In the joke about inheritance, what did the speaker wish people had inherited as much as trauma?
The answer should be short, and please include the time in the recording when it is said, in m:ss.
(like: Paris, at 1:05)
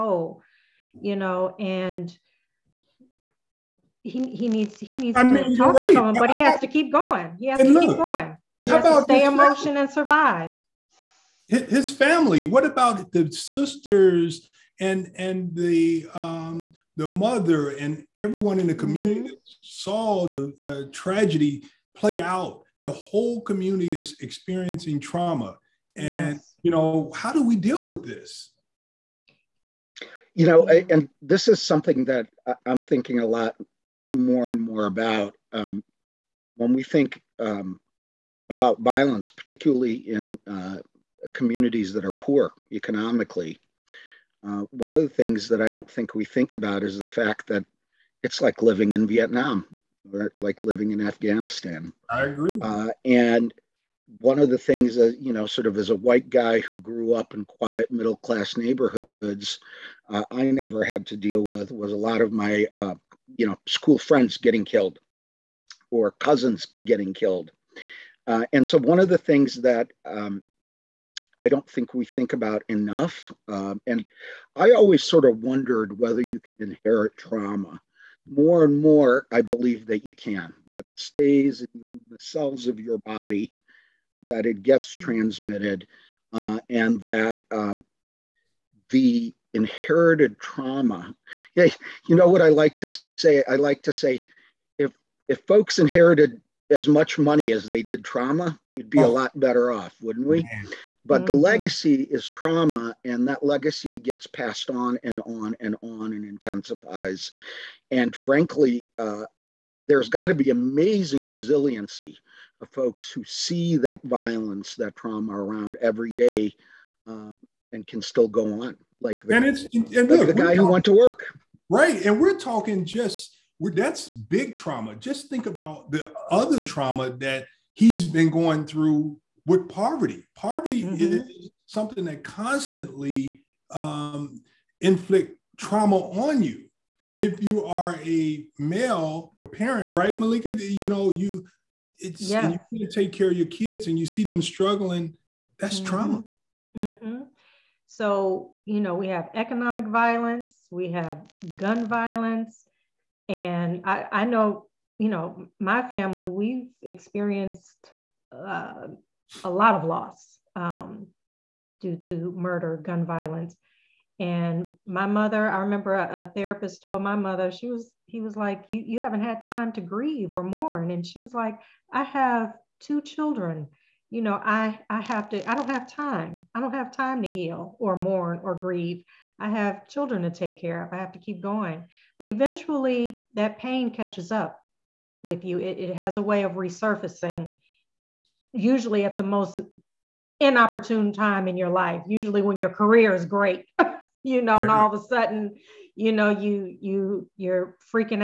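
money, at 1:37.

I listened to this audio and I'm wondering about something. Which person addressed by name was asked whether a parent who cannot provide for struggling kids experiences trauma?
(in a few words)
Meleika.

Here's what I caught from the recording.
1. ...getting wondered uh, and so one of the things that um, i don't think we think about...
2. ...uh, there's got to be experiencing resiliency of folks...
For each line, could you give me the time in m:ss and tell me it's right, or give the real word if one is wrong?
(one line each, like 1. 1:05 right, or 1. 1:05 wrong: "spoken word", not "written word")
1. 1:06 wrong: "killed", not "wondered"
2. 1:48 wrong: "amazing", not "experiencing".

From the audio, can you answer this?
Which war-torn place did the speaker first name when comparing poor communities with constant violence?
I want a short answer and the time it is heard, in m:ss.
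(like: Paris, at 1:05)
Vietnam, at 0:49.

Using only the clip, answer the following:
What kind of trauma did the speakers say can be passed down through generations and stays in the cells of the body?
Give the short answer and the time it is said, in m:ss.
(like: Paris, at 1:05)
inherited trauma, at 1:29.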